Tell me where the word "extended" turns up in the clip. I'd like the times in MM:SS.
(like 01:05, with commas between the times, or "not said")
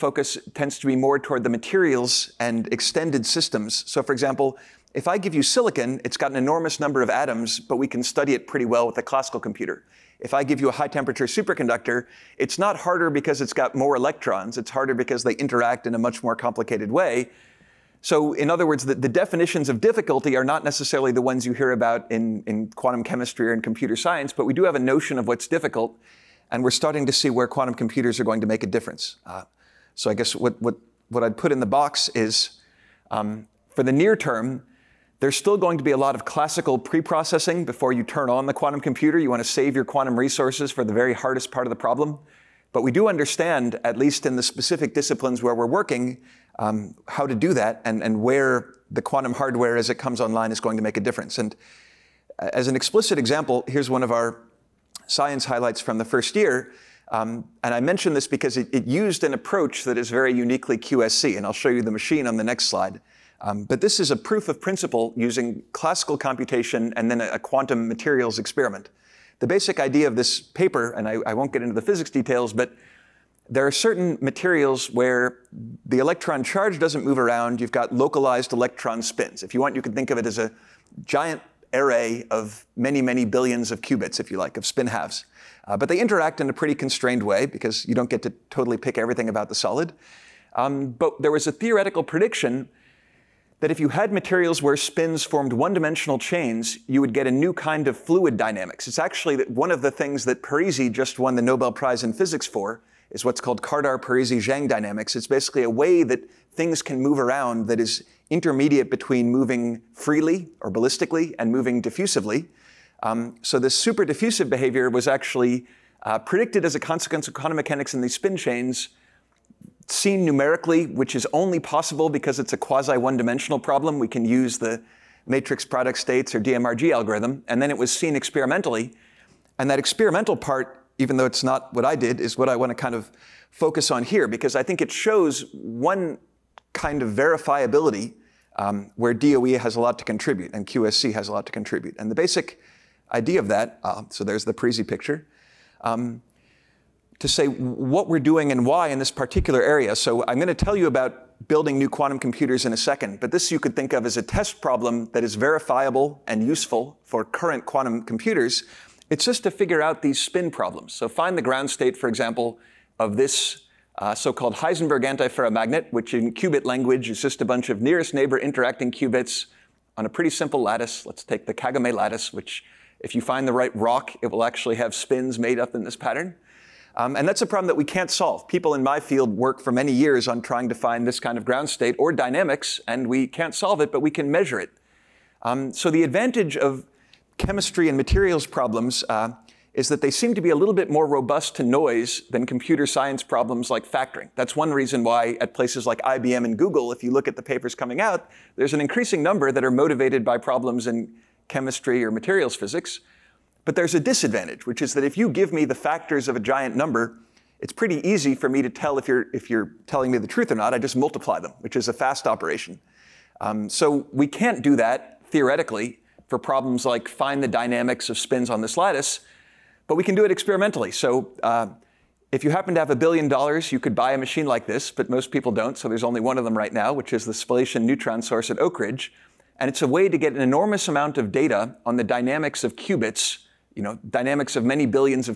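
00:02.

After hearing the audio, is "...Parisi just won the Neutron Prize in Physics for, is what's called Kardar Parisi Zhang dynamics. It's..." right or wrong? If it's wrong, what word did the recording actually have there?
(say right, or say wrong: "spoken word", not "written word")
wrong: "Nobel", not "Neutron".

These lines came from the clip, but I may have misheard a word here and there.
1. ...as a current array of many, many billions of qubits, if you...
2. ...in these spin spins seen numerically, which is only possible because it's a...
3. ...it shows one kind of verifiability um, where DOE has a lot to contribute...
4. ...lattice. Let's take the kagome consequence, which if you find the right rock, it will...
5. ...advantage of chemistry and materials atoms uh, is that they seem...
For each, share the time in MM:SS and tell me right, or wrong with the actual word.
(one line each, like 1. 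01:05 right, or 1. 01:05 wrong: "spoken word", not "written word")
1. 01:20 wrong: "giant", not "current"
2. 01:57 wrong: "chains", not "spins"
3. 02:14 right
4. 02:50 wrong: "lattice", not "consequence"
5. 03:06 wrong: "problems", not "atoms".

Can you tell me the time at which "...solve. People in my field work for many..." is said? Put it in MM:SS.
02:58.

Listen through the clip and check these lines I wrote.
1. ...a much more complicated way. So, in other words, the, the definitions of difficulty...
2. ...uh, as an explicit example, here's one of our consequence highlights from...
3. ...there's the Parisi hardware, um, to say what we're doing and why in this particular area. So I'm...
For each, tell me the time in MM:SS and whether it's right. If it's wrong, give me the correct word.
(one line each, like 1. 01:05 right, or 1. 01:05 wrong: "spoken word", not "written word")
1. 00:15 right
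2. 00:52 wrong: "science", not "consequence"
3. 02:24 wrong: "picture", not "hardware".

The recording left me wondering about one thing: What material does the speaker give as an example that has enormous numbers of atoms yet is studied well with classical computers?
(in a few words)
Silicon.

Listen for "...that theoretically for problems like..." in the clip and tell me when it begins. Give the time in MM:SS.
03:34.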